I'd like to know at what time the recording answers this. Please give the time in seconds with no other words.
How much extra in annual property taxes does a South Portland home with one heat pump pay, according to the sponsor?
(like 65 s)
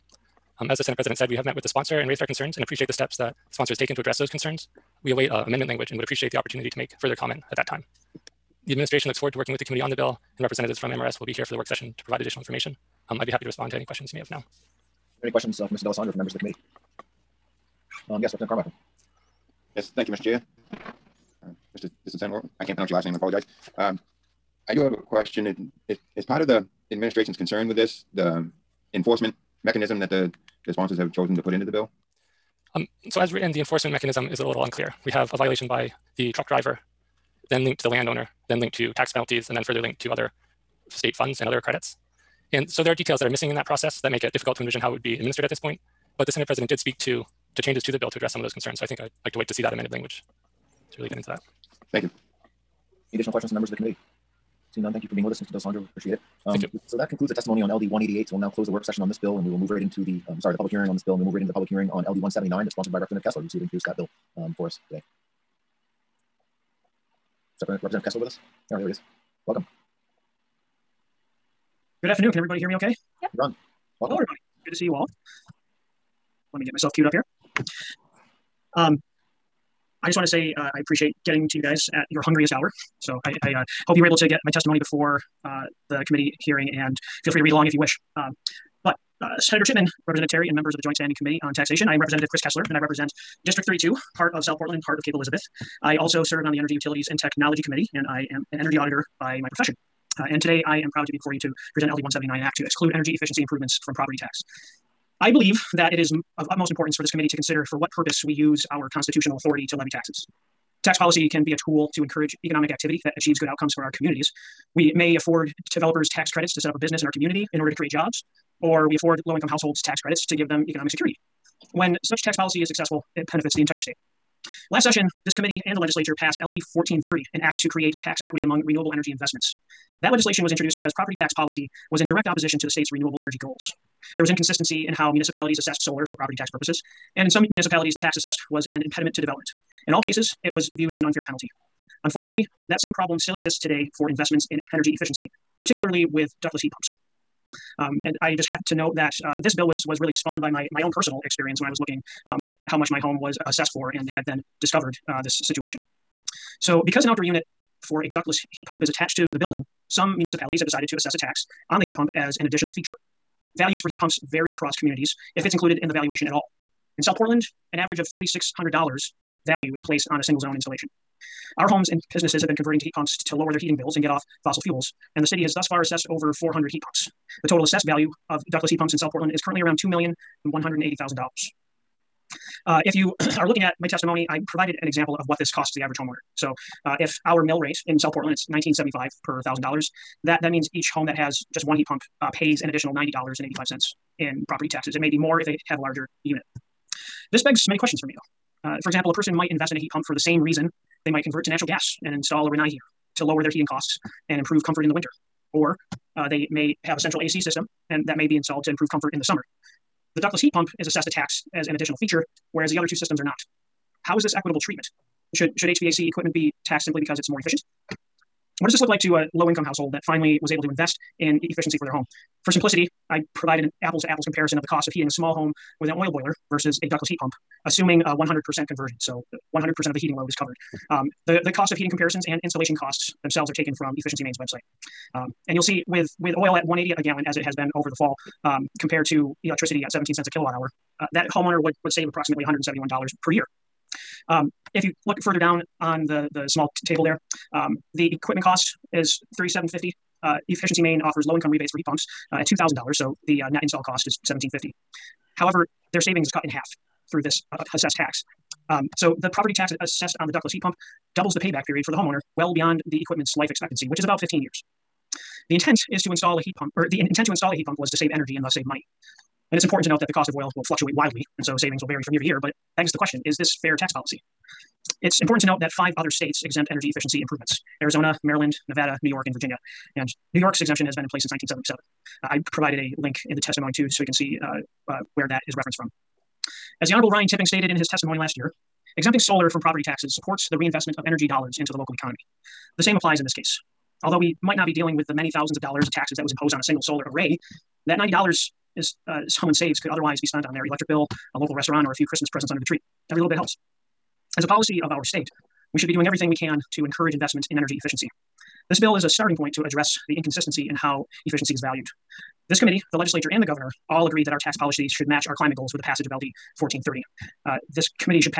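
192 s.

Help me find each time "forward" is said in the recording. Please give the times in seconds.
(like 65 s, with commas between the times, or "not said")
9 s.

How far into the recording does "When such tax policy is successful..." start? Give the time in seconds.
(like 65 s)
121 s.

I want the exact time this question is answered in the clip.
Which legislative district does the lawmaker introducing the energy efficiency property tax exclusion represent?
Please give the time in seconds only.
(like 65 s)
93 s.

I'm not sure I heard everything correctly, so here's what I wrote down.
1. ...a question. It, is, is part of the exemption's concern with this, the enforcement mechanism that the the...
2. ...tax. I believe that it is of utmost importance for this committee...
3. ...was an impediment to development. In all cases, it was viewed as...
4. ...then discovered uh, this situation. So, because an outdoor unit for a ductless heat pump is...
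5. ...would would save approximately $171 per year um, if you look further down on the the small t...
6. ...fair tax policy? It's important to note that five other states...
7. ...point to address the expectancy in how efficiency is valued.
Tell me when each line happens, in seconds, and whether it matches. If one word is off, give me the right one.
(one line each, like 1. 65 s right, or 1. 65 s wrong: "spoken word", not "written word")
1. 24 s wrong: "administration", not "exemption"
2. 104 s right
3. 138 s right
4. 154 s right
5. 241 s right
6. 273 s right
7. 309 s wrong: "inconsistency", not "expectancy".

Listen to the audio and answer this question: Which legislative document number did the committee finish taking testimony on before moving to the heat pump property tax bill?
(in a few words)
LD 188.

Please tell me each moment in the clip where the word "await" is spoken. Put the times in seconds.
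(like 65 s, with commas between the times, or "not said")
5 s.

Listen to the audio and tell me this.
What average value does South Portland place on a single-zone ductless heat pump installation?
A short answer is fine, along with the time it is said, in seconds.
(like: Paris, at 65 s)
$4,600, at 168 s.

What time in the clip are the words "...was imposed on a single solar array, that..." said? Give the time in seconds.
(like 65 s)
296 s.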